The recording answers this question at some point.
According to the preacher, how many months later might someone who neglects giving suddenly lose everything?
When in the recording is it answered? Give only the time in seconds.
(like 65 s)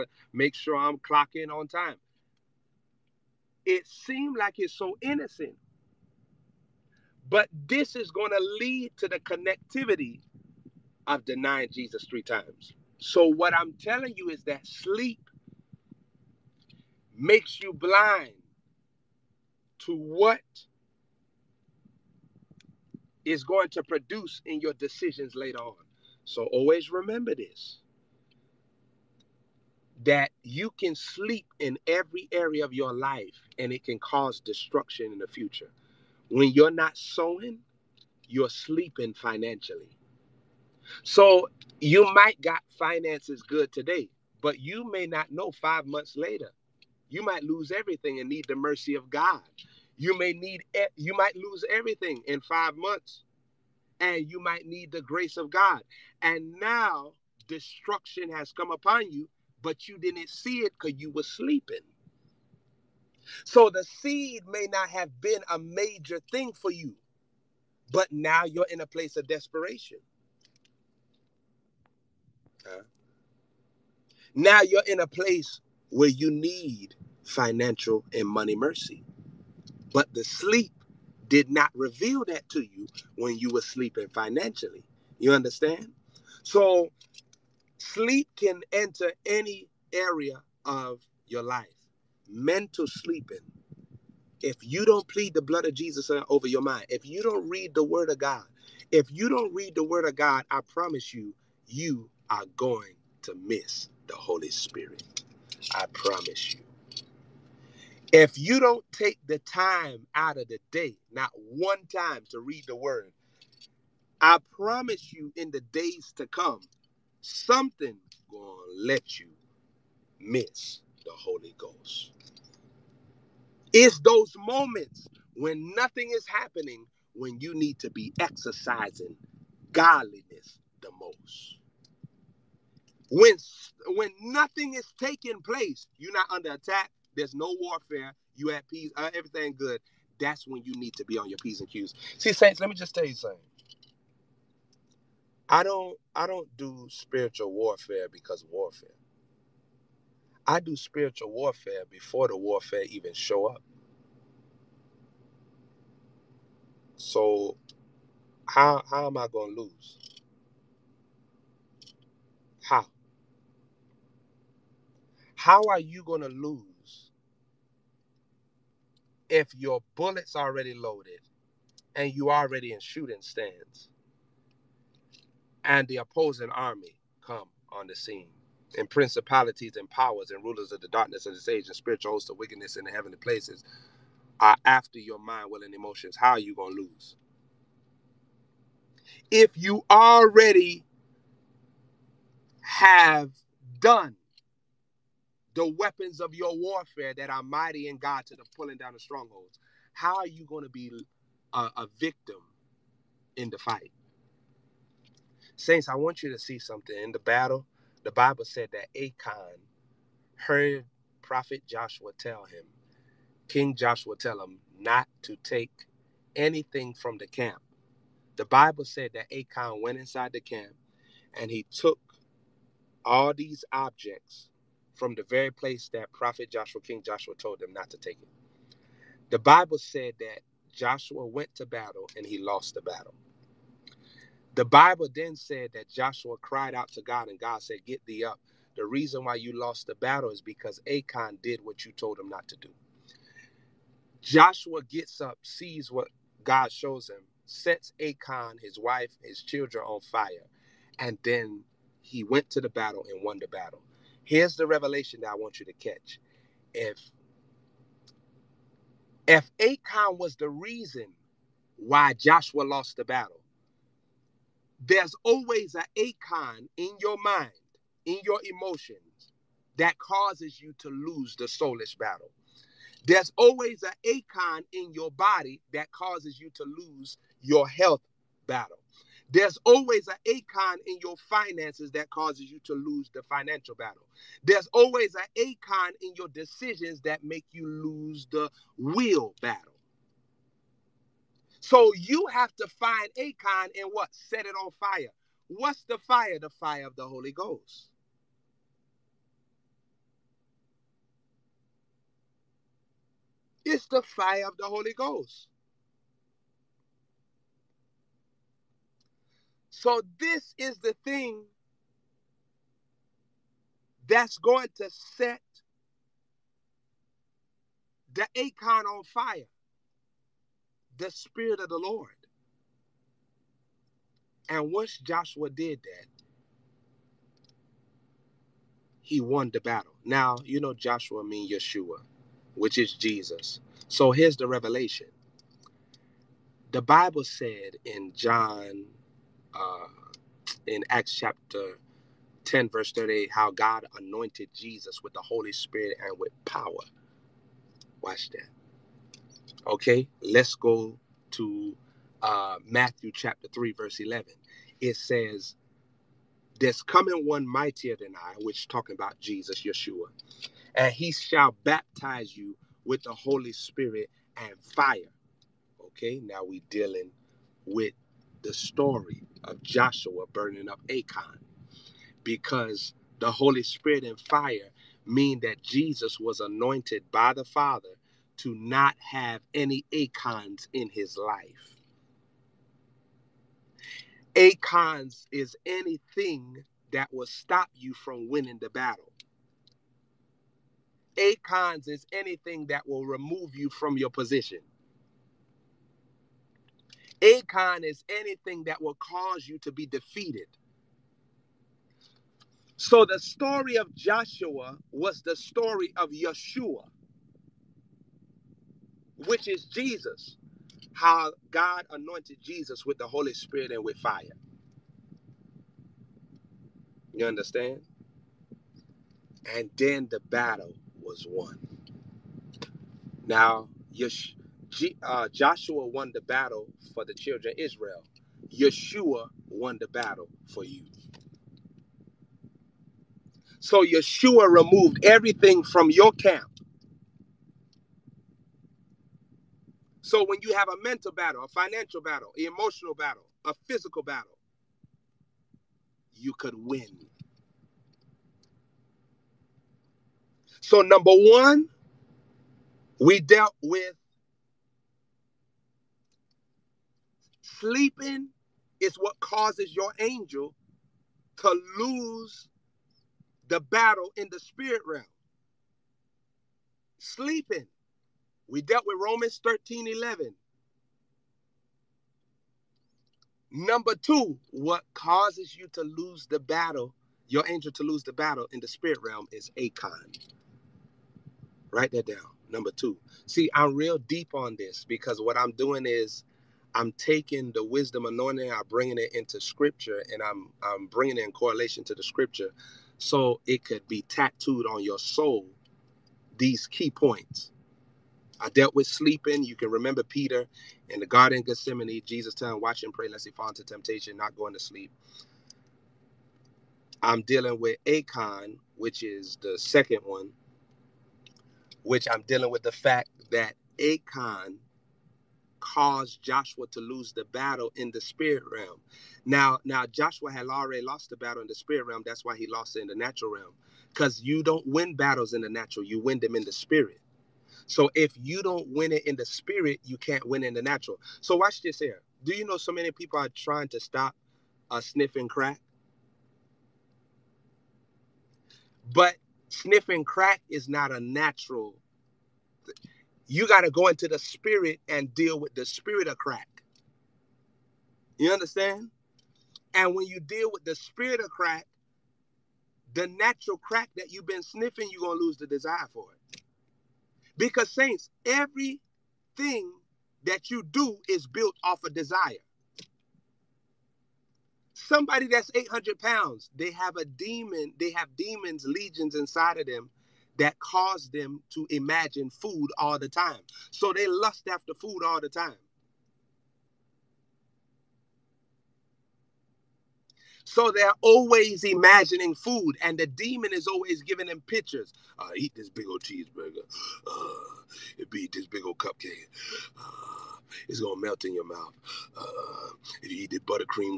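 45 s.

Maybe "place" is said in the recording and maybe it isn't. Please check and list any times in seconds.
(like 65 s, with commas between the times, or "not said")
68 s, 75 s, 135 s, 183 s, 225 s.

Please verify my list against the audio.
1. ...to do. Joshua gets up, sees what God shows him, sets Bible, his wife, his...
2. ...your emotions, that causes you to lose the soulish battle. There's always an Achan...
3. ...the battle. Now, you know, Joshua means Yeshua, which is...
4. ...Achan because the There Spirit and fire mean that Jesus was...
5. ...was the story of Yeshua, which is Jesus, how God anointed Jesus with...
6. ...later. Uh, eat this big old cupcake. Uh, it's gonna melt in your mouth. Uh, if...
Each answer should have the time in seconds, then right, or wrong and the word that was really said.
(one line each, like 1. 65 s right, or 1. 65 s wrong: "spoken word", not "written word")
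1. 242 s wrong: "Achan", not "Bible"
2. 268 s right
3. 329 s right
4. 370 s wrong: "Holy", not "There"
5. 404 s right
6. 586 s wrong: "cheeseburger", not "later".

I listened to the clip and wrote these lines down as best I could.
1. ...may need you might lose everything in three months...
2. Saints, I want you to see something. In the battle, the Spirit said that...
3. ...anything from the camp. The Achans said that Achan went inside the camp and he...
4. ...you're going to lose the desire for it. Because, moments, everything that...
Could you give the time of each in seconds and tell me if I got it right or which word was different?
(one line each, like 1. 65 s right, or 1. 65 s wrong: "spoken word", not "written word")
1. 50 s wrong: "five", not "three"
2. 205 s wrong: "Bible", not "Spirit"
3. 216 s wrong: "Bible", not "Achans"
4. 554 s wrong: "saints", not "moments".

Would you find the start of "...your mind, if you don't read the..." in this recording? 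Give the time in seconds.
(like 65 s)
96 s.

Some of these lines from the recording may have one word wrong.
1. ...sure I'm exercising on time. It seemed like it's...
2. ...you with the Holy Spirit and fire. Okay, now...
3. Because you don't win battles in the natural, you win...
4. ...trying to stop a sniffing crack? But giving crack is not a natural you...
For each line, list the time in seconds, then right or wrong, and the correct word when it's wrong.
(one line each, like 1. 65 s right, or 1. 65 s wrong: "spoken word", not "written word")
1. 0 s wrong: "clocking", not "exercising"
2. 362 s right
3. 523 s right
4. 533 s wrong: "sniffing", not "giving".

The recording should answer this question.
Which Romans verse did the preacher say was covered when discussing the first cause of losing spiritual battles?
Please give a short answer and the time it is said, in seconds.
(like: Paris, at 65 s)
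Romans 13:11, at 468 s.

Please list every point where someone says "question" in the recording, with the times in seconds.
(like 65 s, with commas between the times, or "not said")
not said.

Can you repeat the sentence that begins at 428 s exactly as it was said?
Yeshua won the battle for you.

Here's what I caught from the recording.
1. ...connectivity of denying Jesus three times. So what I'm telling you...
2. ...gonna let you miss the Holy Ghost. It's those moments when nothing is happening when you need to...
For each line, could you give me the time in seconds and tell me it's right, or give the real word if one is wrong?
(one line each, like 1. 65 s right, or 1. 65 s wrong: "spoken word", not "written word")
1. 9 s right
2. 118 s right.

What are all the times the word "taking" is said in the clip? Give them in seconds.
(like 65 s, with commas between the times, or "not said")
134 s, 486 s.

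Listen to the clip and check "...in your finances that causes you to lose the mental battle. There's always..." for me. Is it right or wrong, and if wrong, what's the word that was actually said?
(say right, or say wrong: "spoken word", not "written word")
wrong: "financial", not "mental".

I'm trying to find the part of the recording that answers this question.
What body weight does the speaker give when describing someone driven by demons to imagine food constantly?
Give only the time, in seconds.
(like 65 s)
565 s.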